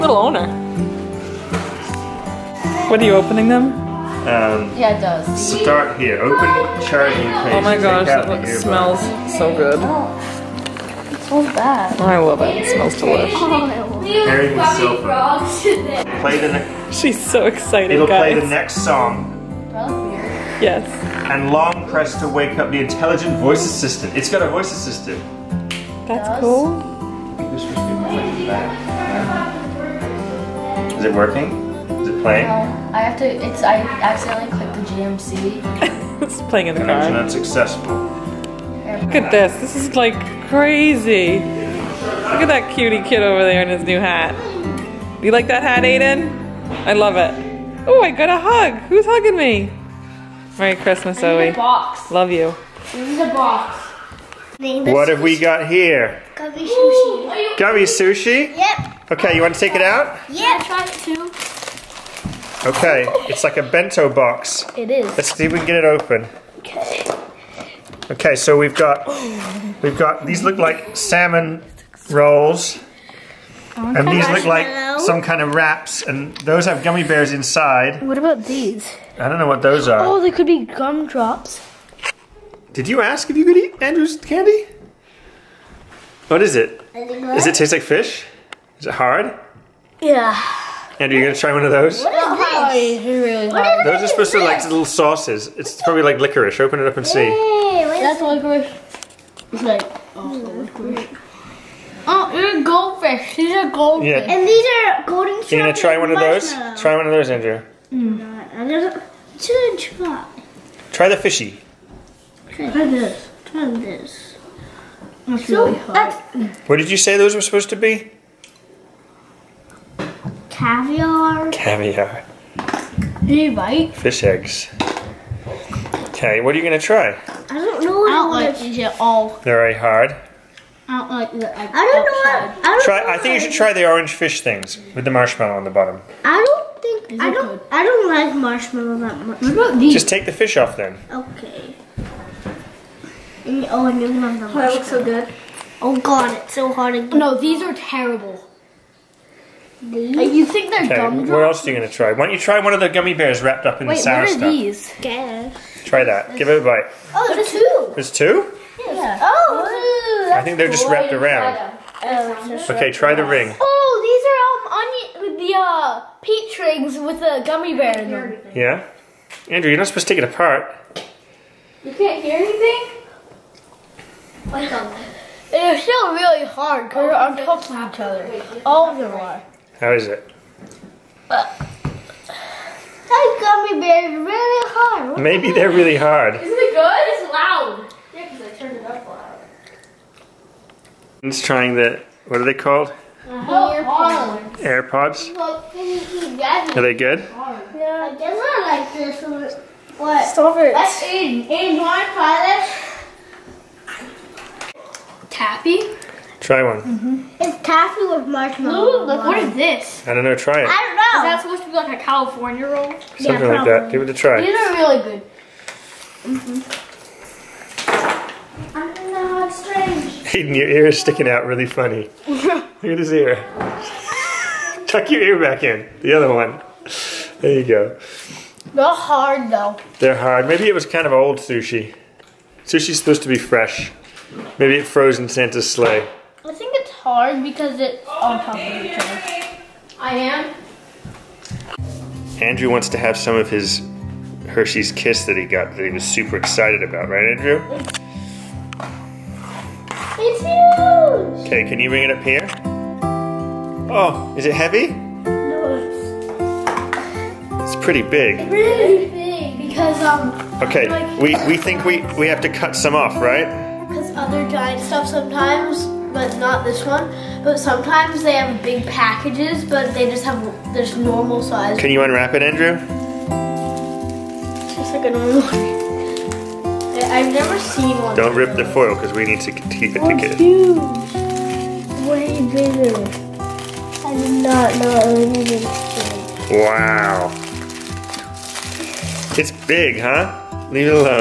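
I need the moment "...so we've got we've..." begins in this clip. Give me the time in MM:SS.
01:08.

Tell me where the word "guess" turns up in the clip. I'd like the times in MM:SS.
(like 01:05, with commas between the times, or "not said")
02:35, 03:18.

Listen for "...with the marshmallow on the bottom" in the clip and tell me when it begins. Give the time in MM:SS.
02:14.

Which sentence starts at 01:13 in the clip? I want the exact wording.
Oh, and these look like some kind of wraps, and those have gummy bears inside.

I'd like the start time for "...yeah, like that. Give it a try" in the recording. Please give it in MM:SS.
03:33.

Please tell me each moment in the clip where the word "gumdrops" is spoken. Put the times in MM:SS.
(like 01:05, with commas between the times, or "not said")
01:20, 02:30.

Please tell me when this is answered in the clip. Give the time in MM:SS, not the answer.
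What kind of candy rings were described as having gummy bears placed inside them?
02:46.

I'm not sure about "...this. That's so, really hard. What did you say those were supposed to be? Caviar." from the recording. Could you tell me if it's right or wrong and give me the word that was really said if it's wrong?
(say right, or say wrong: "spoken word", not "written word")
right.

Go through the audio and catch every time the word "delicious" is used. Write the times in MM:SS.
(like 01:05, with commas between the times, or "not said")
00:12.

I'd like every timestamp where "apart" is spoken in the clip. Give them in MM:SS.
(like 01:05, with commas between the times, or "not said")
02:50.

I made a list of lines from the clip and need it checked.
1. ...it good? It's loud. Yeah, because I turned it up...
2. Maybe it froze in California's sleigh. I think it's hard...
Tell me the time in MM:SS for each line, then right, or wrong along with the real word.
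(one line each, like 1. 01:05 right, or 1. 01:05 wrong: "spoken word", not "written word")
1. 03:06 right
2. 03:54 wrong: "Santa", not "California".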